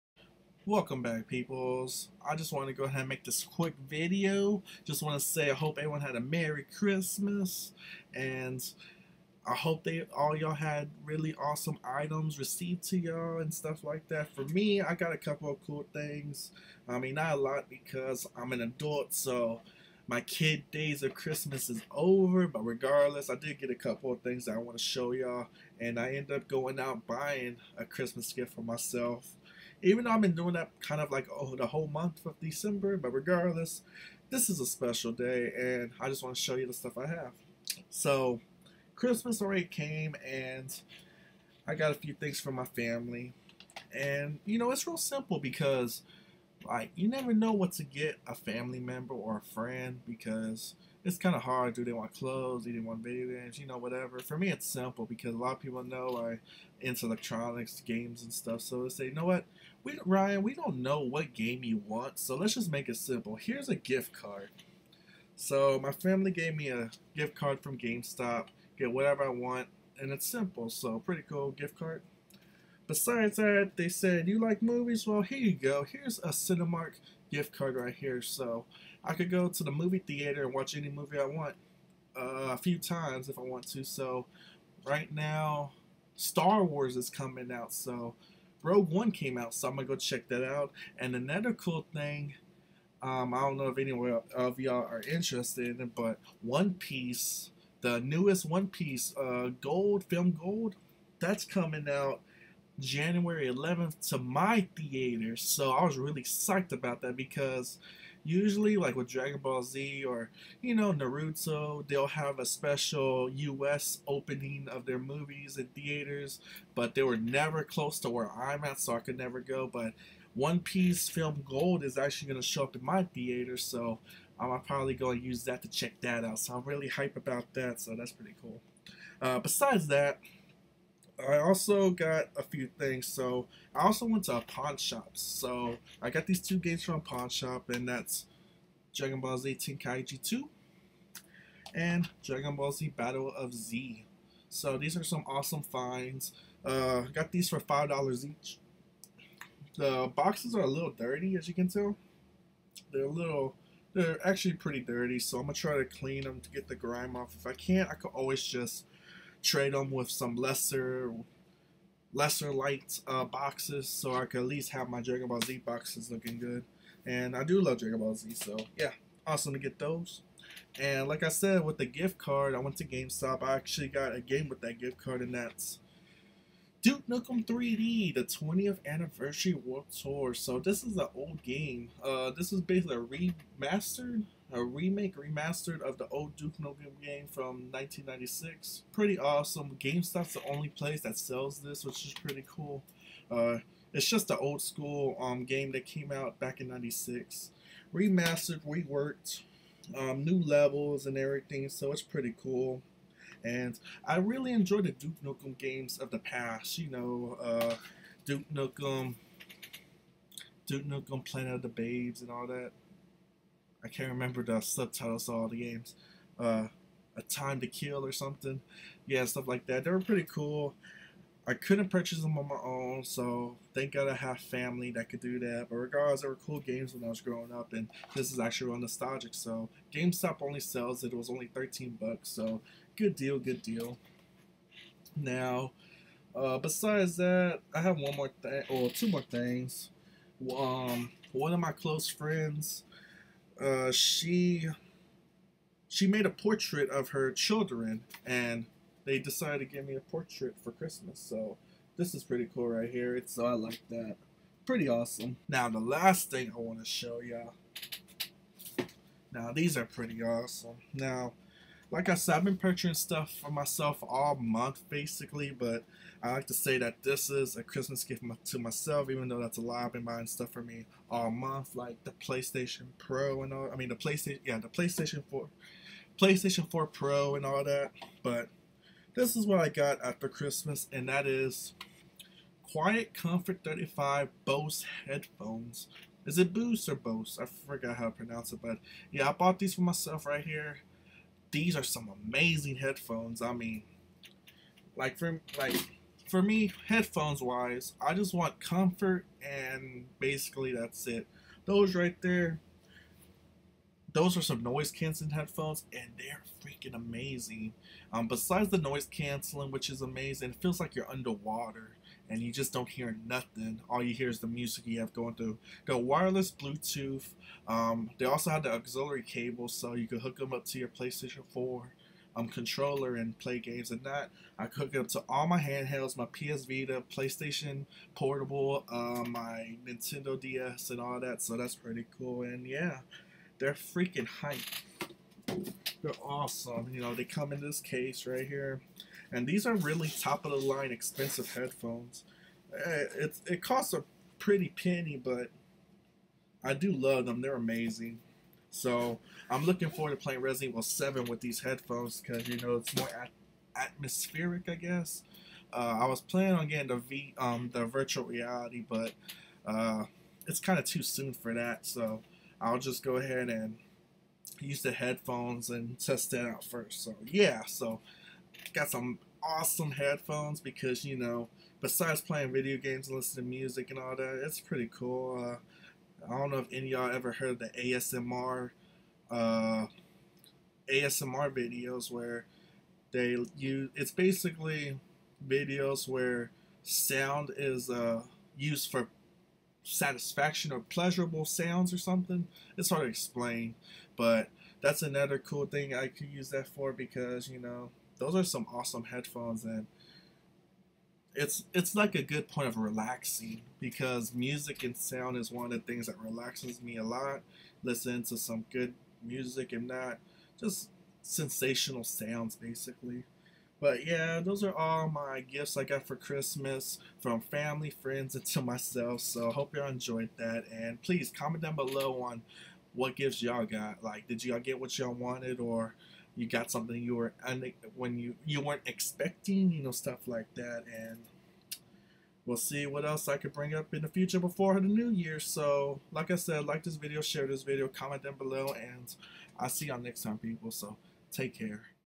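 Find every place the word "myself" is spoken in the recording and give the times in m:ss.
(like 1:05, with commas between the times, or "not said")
0:28, 4:23, 4:28, 4:49, 6:58.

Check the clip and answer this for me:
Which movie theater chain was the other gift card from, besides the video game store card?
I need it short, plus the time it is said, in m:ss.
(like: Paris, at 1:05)
Cinemark, at 1:16.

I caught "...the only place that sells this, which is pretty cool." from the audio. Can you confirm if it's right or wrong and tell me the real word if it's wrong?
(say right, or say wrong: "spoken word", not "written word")
right.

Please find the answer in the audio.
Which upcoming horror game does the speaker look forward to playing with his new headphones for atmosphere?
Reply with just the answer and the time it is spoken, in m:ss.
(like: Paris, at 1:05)
Resident Evil 7, at 5:50.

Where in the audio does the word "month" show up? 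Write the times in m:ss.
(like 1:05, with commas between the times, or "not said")
0:31, 4:24, 4:31.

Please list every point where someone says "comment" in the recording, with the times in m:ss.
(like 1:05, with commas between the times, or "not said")
7:01, 7:17.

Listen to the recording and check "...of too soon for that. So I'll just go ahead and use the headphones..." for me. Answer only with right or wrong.
right.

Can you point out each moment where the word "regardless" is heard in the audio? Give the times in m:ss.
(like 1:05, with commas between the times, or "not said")
0:22, 0:33, 3:45.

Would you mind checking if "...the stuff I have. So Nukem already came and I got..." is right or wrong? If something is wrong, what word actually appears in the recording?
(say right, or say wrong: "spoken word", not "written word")
wrong: "Christmas", not "Nukem".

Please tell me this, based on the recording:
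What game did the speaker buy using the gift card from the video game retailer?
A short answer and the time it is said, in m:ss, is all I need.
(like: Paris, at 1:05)
Duke Nukem 3D, at 2:56.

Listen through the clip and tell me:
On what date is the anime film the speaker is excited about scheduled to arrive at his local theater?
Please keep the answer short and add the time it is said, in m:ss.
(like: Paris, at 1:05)
January 11th, at 1:42.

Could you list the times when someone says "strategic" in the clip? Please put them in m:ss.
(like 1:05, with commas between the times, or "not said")
not said.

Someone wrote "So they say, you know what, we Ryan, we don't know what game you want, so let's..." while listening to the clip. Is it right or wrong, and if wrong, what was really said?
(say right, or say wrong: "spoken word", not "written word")
right.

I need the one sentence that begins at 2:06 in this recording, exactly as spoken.
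So I'm really hype about that, so that's pretty cool.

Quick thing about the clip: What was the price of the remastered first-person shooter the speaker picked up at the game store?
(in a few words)
$13.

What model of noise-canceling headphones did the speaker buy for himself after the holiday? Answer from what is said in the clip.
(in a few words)
Quiet Comfort 35.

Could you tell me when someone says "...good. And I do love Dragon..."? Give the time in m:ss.
2:46.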